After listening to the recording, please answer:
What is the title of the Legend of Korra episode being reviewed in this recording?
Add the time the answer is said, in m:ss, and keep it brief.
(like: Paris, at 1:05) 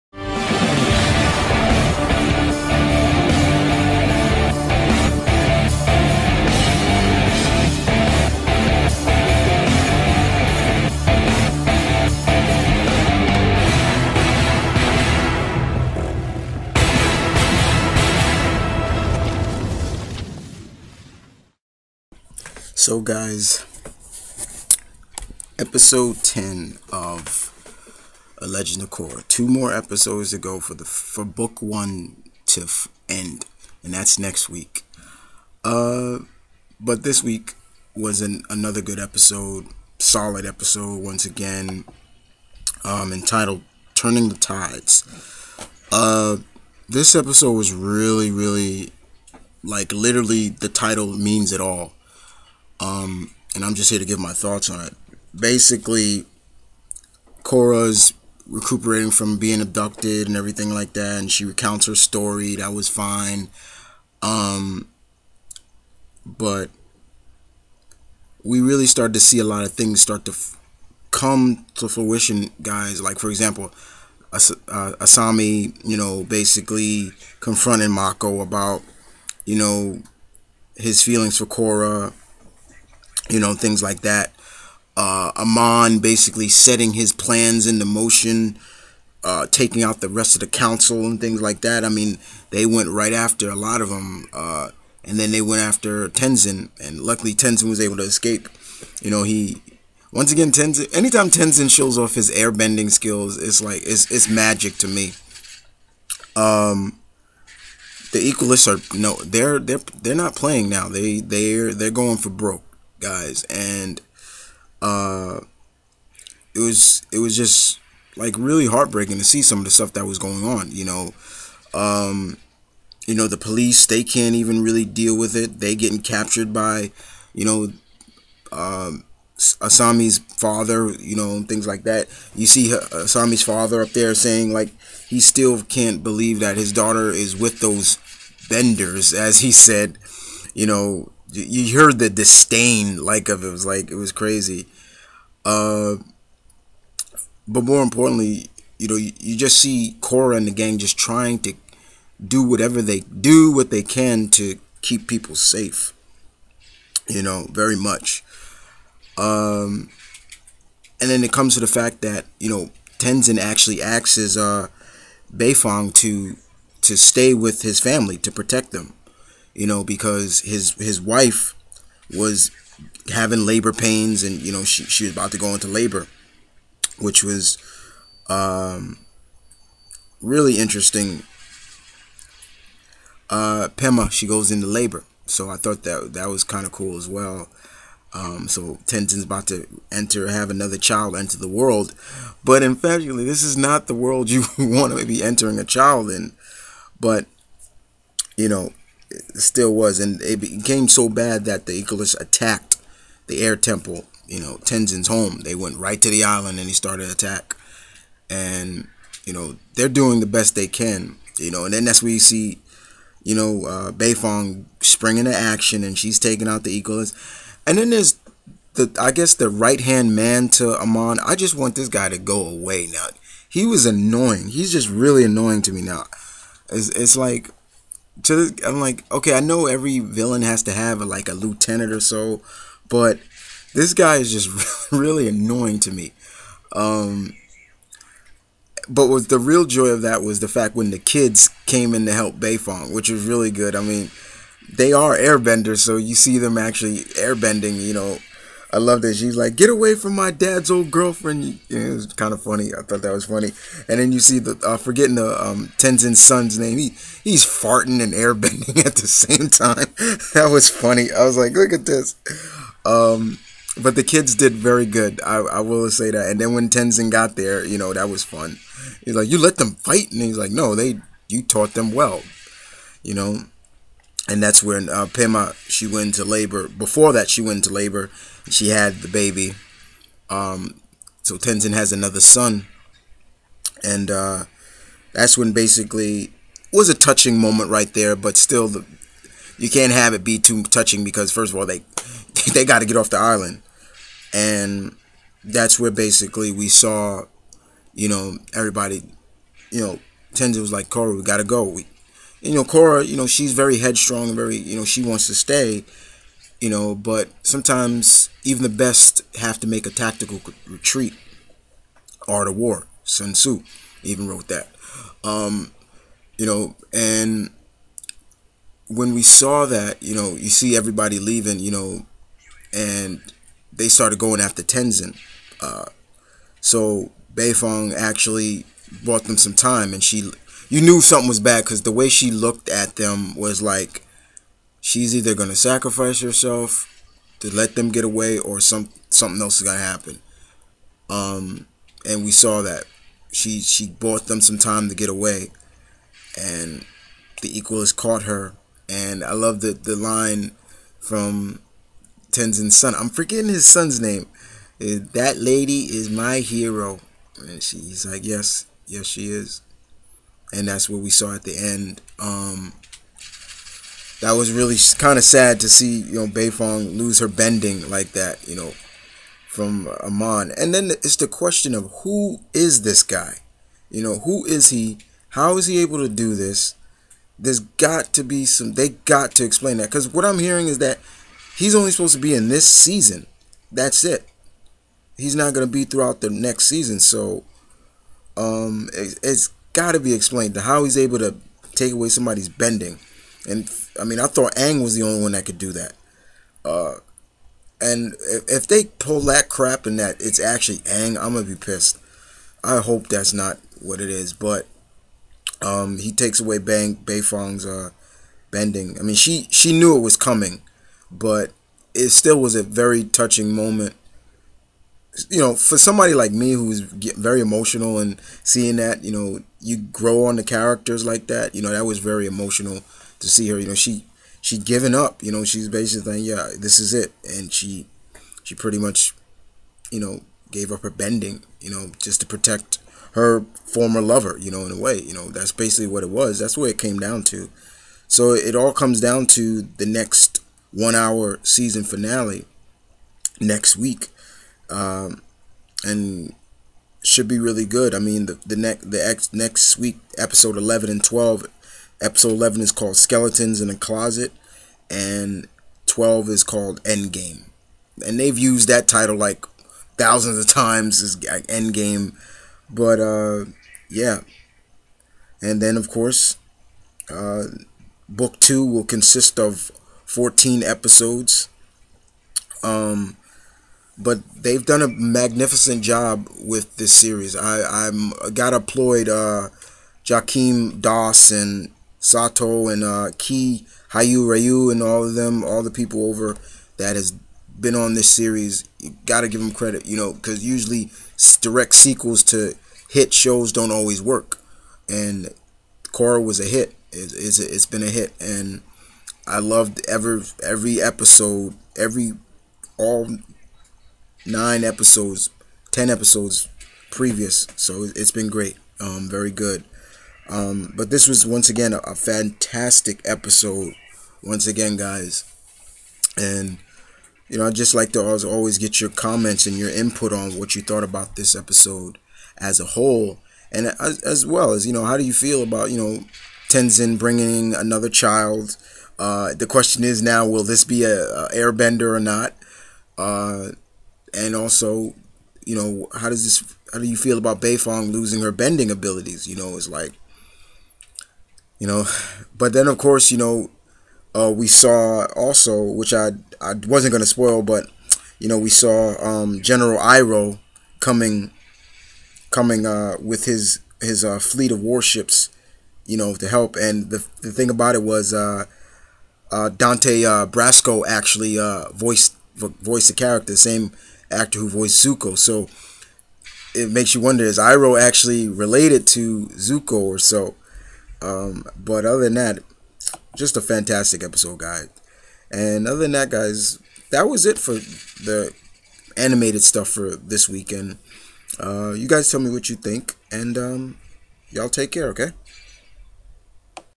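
Turning the Tides, at 0:43.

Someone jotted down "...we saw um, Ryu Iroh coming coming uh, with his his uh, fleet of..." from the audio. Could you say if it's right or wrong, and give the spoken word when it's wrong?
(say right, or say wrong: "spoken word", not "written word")
wrong: "General", not "Ryu".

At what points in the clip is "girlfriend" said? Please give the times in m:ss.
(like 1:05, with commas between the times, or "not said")
4:10.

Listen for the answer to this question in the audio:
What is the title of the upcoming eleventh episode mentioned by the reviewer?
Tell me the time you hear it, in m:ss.
7:32.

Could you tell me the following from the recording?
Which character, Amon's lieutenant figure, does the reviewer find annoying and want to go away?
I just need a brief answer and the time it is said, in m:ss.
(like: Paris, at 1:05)
the right hand man to Amon, at 3:39.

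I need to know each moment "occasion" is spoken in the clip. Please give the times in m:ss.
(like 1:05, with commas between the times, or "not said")
not said.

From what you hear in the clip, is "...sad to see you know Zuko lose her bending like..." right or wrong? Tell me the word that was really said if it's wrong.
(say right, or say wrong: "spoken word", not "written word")
wrong: "Beifong", not "Zuko".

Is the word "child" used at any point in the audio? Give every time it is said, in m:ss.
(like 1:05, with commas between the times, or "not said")
3:10, 3:15, 8:47.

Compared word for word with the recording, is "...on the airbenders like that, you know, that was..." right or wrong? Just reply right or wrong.
wrong.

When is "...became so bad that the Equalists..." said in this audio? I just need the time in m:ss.
3:20.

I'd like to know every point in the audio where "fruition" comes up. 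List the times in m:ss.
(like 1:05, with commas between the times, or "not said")
1:11.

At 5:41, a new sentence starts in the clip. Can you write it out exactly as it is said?
Um, and we saw that she she bought them some time to get away, and the equalist caught her.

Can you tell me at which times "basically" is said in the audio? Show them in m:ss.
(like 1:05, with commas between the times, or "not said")
0:55, 1:16, 1:25, 4:45, 4:55, 7:05, 7:15.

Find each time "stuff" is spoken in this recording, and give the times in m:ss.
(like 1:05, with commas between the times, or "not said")
1:59, 9:39.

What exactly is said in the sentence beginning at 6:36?
Uh, and if they pull that crap and that it's actually Aang, I'm gonna be pissed.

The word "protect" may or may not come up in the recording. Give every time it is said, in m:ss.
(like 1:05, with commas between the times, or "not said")
2:48, 7:12.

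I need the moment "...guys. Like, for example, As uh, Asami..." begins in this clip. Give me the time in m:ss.
1:12.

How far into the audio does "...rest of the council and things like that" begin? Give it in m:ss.
1:30.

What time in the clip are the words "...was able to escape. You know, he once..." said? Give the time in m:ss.
1:37.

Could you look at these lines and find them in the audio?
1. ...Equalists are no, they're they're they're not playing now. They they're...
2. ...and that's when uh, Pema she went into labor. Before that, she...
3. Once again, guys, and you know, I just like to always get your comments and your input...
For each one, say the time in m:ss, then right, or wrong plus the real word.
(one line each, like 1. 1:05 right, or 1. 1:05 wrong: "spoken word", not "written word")
1. 1:48 right
2. 4:34 right
3. 8:34 right.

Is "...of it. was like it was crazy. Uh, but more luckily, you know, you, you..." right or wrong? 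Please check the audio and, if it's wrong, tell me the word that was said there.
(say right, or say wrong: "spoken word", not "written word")
wrong: "importantly", not "luckily".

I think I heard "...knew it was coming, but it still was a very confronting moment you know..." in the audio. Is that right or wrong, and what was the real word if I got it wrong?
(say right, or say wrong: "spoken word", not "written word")
wrong: "touching", not "confronting".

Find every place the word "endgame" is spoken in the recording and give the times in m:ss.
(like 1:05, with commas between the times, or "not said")
7:36, 7:41.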